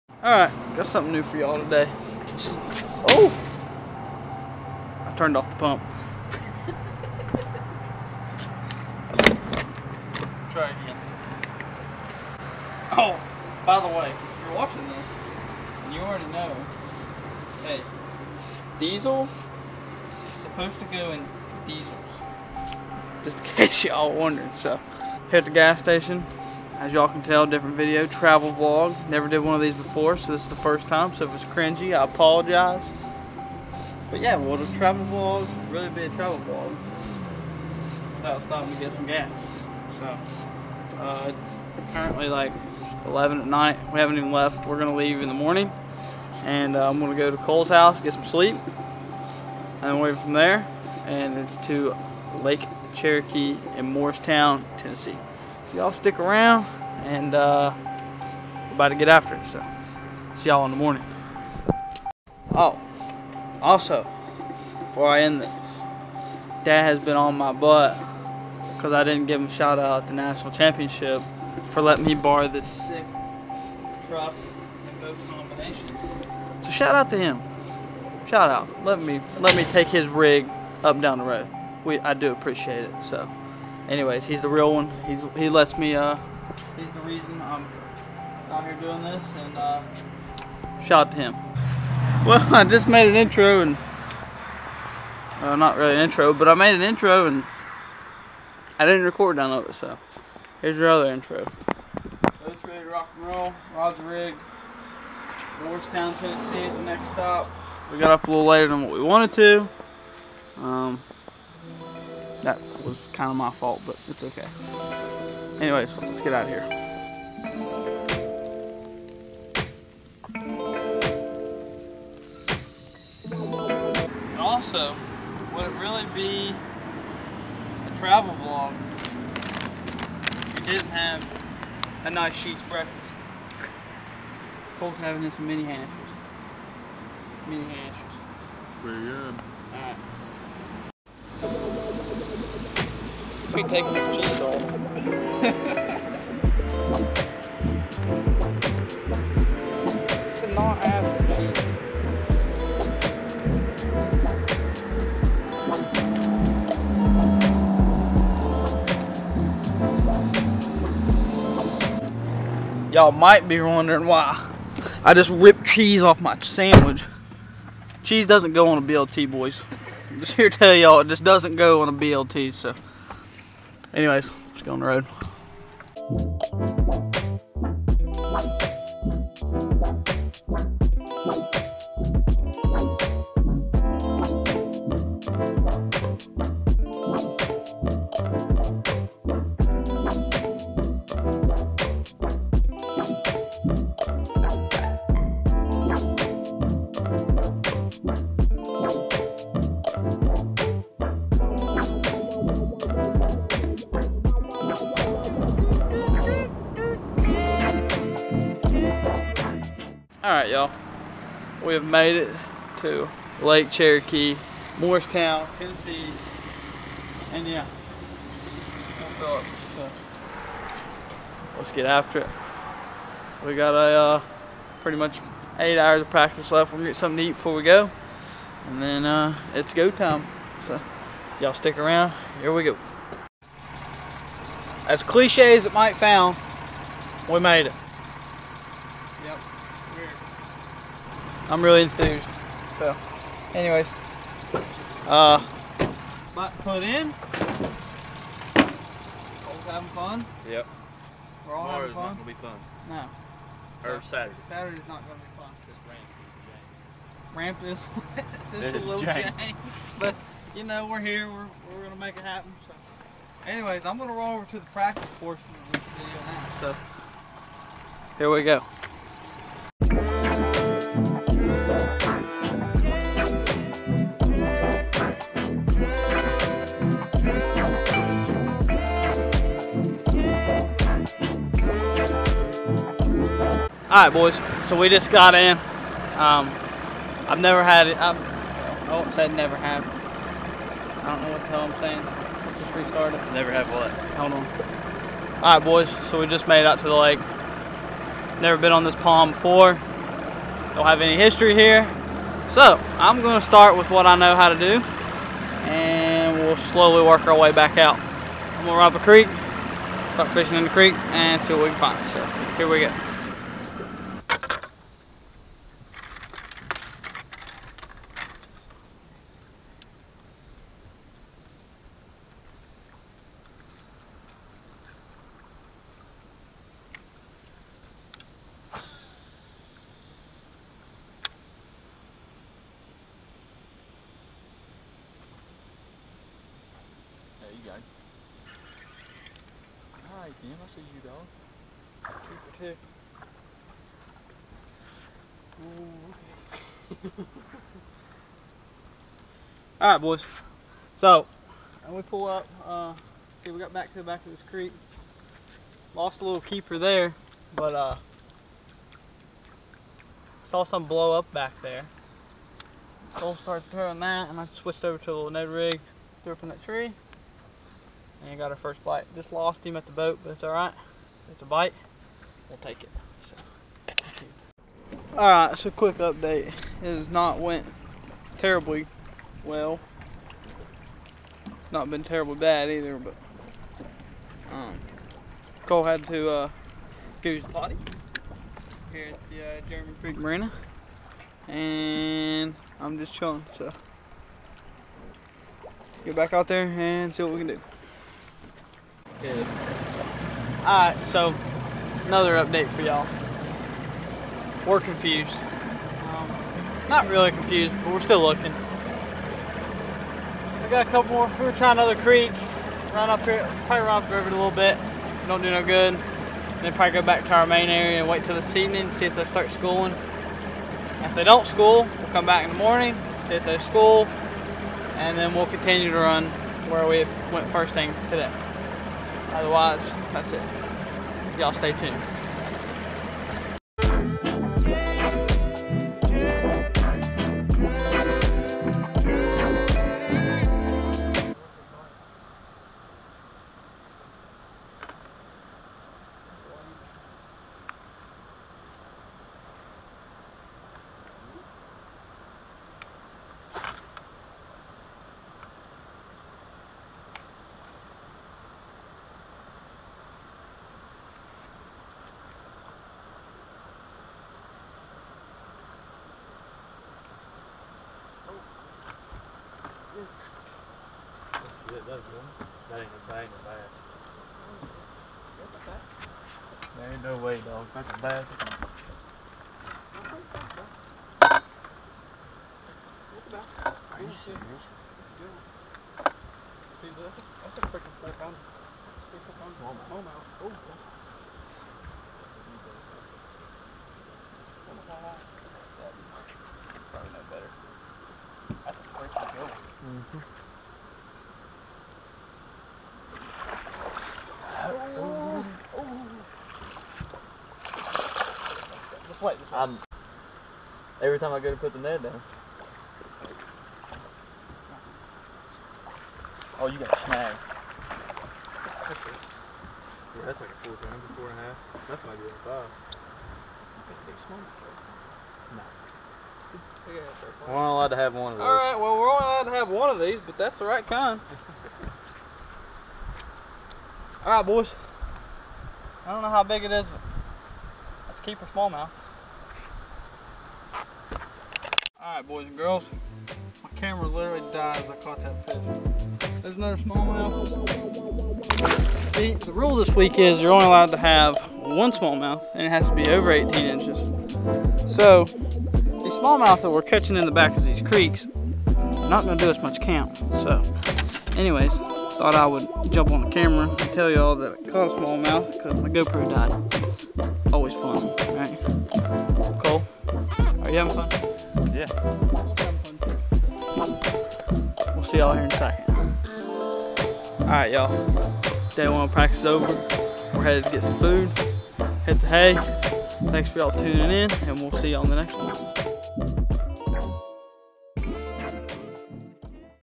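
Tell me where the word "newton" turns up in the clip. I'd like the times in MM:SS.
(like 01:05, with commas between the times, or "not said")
not said.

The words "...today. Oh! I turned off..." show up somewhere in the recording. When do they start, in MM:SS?
00:01.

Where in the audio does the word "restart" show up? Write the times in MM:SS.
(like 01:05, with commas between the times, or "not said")
04:52.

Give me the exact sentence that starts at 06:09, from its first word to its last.
Just lost him at the boat, but it's all right.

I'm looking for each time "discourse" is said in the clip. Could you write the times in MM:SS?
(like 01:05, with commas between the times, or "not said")
not said.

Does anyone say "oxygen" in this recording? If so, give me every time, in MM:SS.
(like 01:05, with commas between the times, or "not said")
not said.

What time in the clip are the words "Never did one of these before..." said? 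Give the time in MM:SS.
00:29.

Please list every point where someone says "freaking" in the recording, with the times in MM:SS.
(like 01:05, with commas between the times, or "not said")
08:07, 08:18.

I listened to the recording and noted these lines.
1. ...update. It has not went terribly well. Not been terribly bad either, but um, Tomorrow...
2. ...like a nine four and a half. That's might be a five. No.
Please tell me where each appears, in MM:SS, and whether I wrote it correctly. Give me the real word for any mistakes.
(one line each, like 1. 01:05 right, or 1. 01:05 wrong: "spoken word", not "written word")
1. 06:15 wrong: "Cole", not "Tomorrow"
2. 08:40 wrong: "four", not "nine".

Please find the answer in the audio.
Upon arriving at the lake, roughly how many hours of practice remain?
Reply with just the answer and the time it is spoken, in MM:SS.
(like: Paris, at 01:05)
8, at 03:45.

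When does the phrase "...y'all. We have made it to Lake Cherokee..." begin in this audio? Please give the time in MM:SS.
03:30.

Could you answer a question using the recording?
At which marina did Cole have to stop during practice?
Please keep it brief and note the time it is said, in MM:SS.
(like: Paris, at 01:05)
German Creek Marina, at 06:29.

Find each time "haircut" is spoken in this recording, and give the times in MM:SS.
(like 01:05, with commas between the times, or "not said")
not said.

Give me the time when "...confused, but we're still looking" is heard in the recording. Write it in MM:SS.
06:47.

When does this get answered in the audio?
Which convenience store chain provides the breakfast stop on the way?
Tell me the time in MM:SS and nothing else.
02:12.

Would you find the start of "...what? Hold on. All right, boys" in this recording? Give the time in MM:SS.
04:53.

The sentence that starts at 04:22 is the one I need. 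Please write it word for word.
So, anyways, I'm gonna roll over to the practice portion of this video now.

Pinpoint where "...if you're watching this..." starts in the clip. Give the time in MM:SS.
00:14.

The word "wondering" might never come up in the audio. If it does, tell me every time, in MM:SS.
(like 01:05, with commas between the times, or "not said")
00:24, 02:43.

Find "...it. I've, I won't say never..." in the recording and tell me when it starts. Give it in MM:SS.
04:47.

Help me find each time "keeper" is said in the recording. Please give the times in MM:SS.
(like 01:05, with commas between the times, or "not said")
05:56, 08:58.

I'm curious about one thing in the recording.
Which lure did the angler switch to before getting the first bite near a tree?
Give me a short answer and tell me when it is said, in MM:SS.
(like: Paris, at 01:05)
Ned rig, at 06:05.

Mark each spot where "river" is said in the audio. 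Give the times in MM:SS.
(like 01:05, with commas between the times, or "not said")
06:54.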